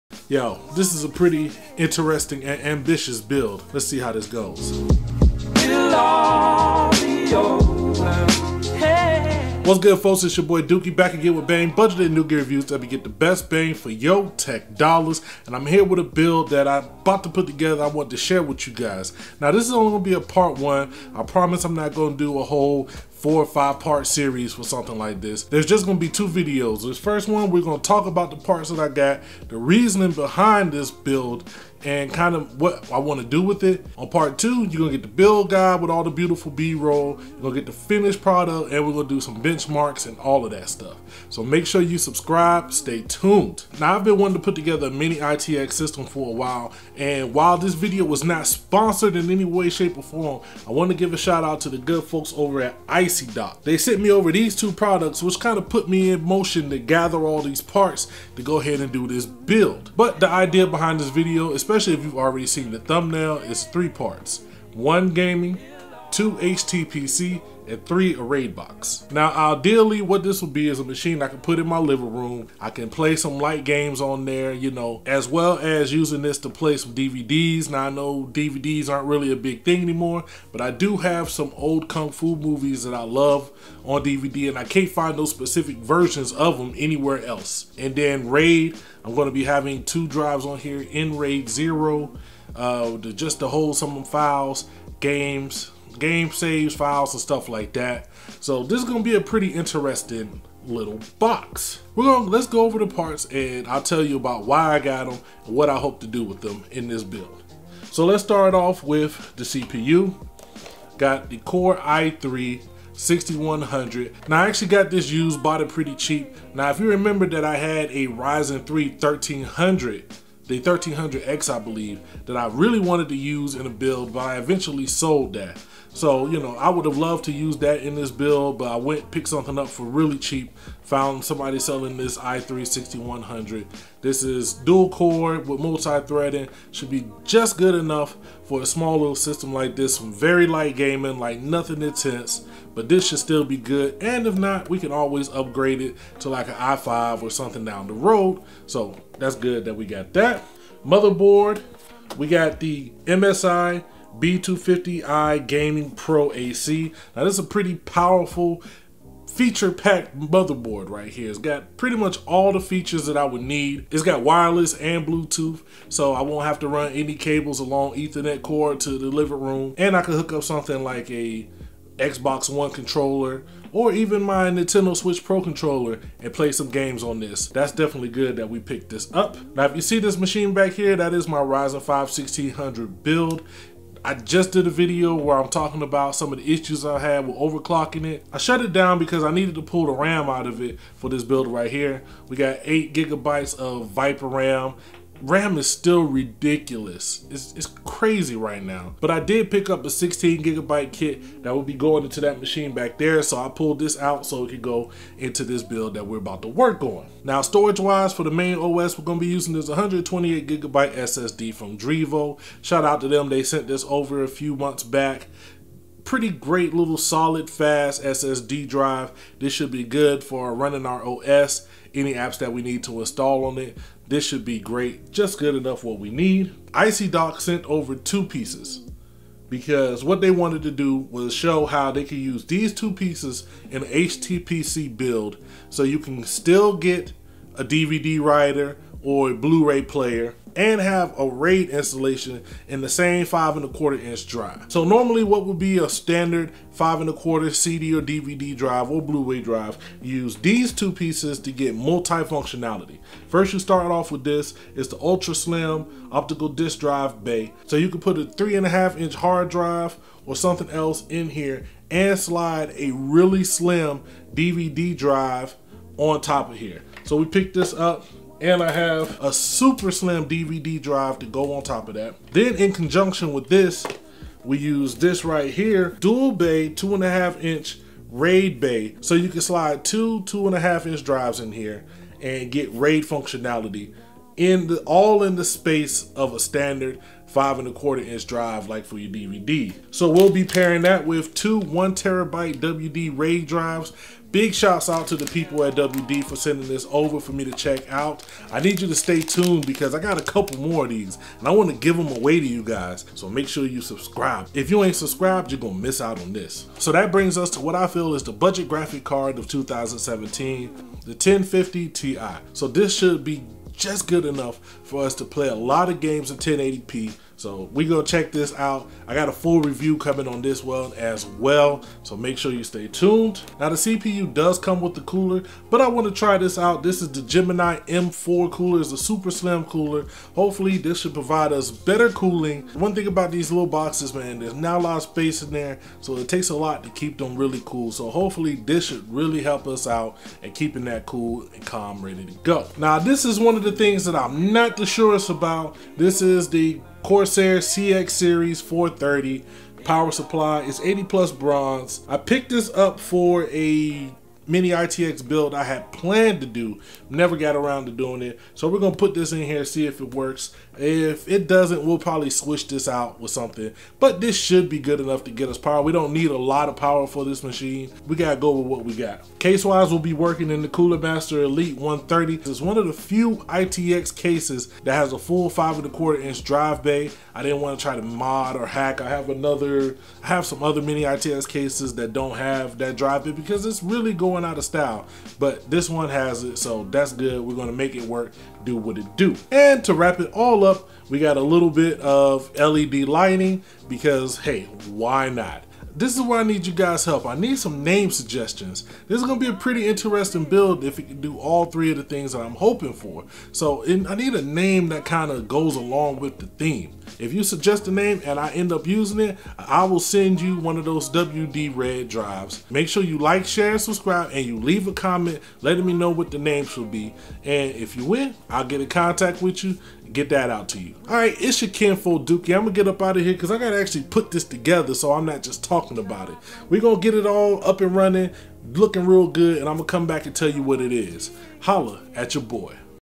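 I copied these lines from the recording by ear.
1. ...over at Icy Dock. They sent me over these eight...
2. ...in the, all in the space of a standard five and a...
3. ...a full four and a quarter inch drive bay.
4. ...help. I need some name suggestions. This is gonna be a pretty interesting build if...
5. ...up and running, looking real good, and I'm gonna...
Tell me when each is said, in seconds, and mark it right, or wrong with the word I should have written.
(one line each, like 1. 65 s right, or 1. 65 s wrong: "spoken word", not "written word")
1. 52 s wrong: "two", not "eight"
2. 284 s right
3. 375 s wrong: "five", not "four"
4. 397 s right
5. 427 s right.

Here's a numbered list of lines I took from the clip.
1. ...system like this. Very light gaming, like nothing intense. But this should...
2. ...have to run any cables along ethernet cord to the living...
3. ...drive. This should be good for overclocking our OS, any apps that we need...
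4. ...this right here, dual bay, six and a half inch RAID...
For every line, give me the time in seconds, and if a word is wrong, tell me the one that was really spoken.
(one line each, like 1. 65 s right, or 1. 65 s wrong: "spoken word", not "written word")
1. 139 s right
2. 166 s right
3. 218 s wrong: "running", not "overclocking"
4. 274 s wrong: "two", not "six".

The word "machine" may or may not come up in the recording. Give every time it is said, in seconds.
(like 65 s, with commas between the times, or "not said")
70 s, 180 s, 202 s, 367 s.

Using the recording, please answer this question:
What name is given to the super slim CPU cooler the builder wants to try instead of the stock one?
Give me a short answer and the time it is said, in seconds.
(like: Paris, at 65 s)
Gemini M4, at 327 s.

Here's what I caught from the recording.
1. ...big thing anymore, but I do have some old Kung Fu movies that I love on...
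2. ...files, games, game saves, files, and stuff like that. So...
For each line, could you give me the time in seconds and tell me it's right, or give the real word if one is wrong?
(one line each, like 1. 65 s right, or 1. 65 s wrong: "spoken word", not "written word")
1. 79 s right
2. 94 s right.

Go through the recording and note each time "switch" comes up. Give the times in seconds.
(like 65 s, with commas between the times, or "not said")
174 s, 362 s.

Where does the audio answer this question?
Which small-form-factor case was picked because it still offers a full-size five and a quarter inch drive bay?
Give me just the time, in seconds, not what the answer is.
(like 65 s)
370 s.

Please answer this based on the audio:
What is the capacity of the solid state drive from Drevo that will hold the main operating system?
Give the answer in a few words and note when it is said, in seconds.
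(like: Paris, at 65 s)
128 gigabytes, at 209 s.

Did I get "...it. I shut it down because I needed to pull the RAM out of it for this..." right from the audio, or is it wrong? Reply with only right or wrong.
right.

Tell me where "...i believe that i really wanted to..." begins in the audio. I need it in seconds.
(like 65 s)
121 s.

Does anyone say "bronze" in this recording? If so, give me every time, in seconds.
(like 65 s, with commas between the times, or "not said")
351 s.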